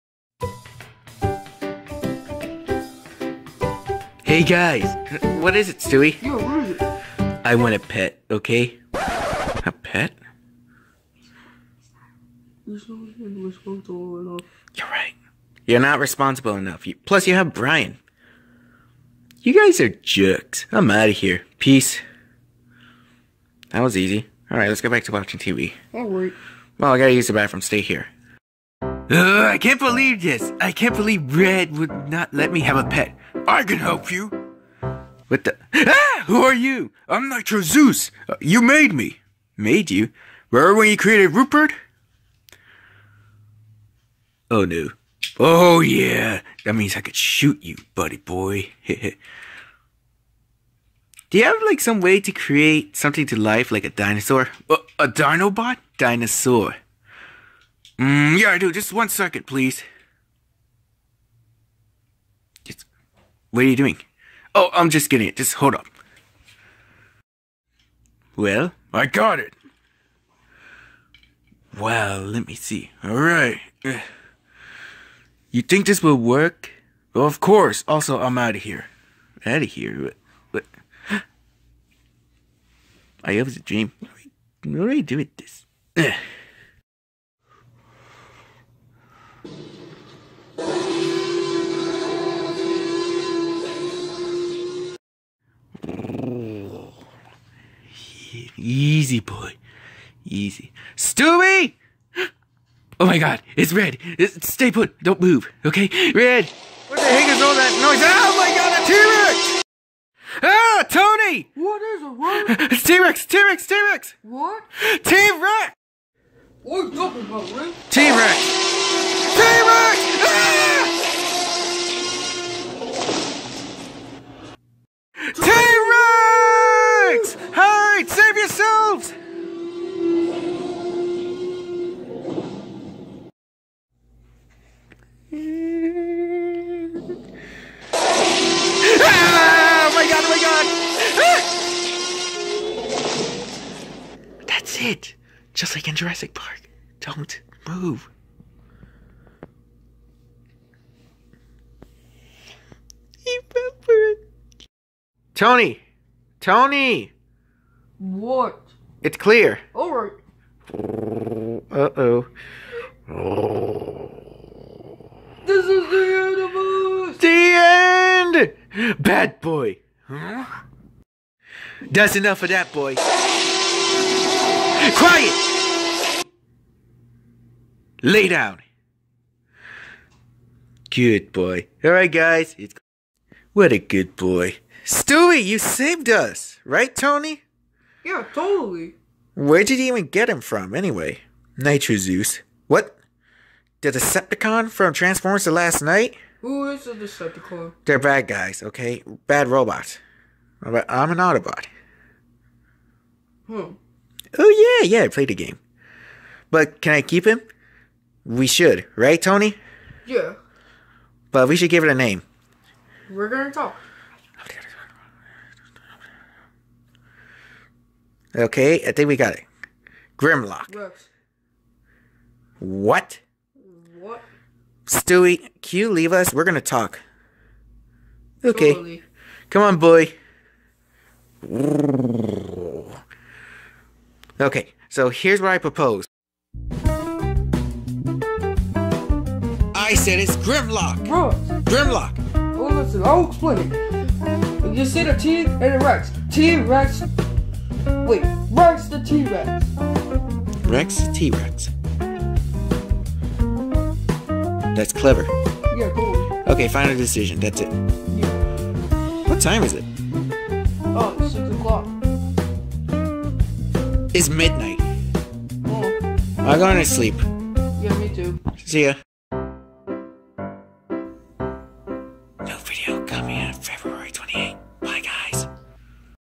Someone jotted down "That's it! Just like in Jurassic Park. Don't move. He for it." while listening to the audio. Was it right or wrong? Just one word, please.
right.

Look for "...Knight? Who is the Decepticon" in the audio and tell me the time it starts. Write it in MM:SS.
03:15.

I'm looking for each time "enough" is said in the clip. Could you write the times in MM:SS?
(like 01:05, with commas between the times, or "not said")
00:16, 02:52.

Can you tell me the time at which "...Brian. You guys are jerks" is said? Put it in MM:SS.
00:17.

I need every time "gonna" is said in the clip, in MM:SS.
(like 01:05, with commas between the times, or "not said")
03:33, 03:46.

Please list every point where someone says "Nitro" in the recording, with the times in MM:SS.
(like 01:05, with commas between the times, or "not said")
00:37, 03:11.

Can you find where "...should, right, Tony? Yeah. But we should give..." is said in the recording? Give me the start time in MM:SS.
03:28.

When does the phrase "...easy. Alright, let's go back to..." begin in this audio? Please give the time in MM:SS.
00:23.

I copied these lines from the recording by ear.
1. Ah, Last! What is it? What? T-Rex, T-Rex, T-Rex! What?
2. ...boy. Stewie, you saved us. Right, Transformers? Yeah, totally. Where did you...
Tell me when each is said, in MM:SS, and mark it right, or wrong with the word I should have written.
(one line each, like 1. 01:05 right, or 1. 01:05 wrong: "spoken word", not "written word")
1. 01:50 wrong: "Tony", not "Last"
2. 03:04 wrong: "Tony", not "Transformers".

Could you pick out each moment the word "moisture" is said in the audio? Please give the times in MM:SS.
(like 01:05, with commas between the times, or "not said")
not said.